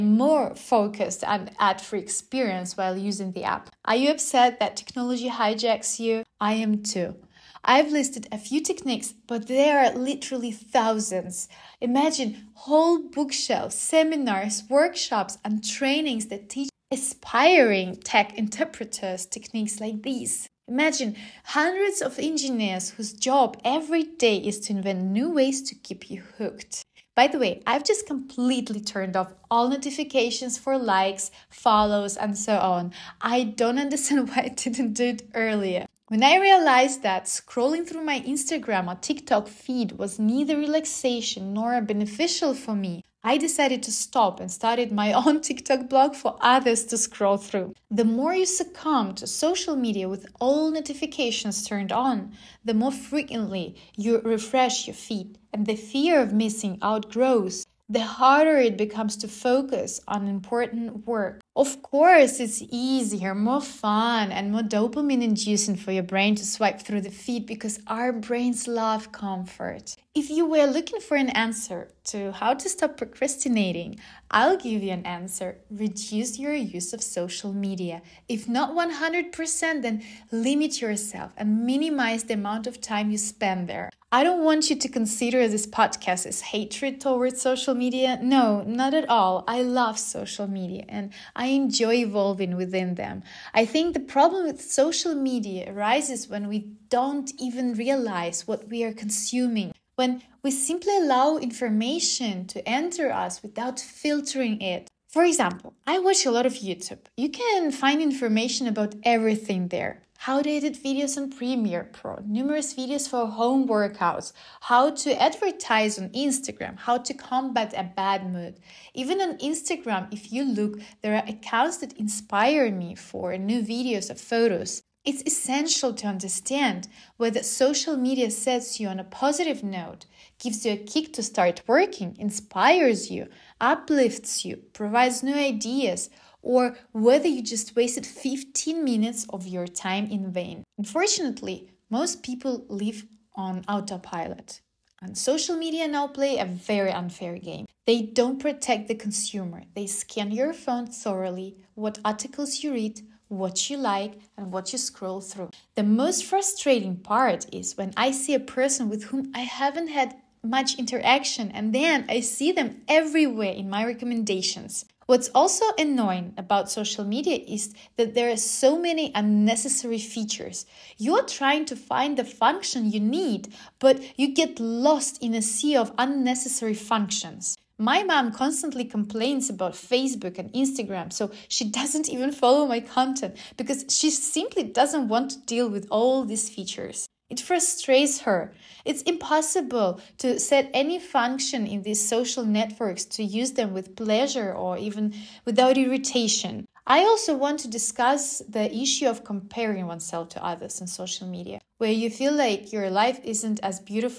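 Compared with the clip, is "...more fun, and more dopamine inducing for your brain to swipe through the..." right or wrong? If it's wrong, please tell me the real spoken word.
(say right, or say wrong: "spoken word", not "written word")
right.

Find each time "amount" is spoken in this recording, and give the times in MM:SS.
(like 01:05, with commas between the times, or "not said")
01:22.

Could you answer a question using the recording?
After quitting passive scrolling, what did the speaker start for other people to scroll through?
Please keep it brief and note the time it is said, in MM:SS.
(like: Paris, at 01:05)
TikTok blog, at 00:45.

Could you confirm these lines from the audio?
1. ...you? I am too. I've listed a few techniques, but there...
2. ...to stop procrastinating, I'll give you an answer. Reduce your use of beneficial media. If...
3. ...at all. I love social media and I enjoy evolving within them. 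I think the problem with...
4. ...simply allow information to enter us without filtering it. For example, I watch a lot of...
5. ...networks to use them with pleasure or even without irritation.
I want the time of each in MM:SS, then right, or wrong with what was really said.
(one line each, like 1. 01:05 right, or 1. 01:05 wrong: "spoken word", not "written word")
1. 00:05 right
2. 01:12 wrong: "social", not "beneficial"
3. 01:28 right
4. 01:40 right
5. 03:12 right.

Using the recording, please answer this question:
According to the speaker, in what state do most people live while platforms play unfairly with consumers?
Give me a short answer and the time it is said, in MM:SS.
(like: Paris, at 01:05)
autopilot, at 02:23.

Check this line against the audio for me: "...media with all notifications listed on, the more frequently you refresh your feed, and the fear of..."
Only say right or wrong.
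wrong.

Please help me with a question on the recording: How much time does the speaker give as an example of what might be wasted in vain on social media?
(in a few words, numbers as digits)
15 minutes.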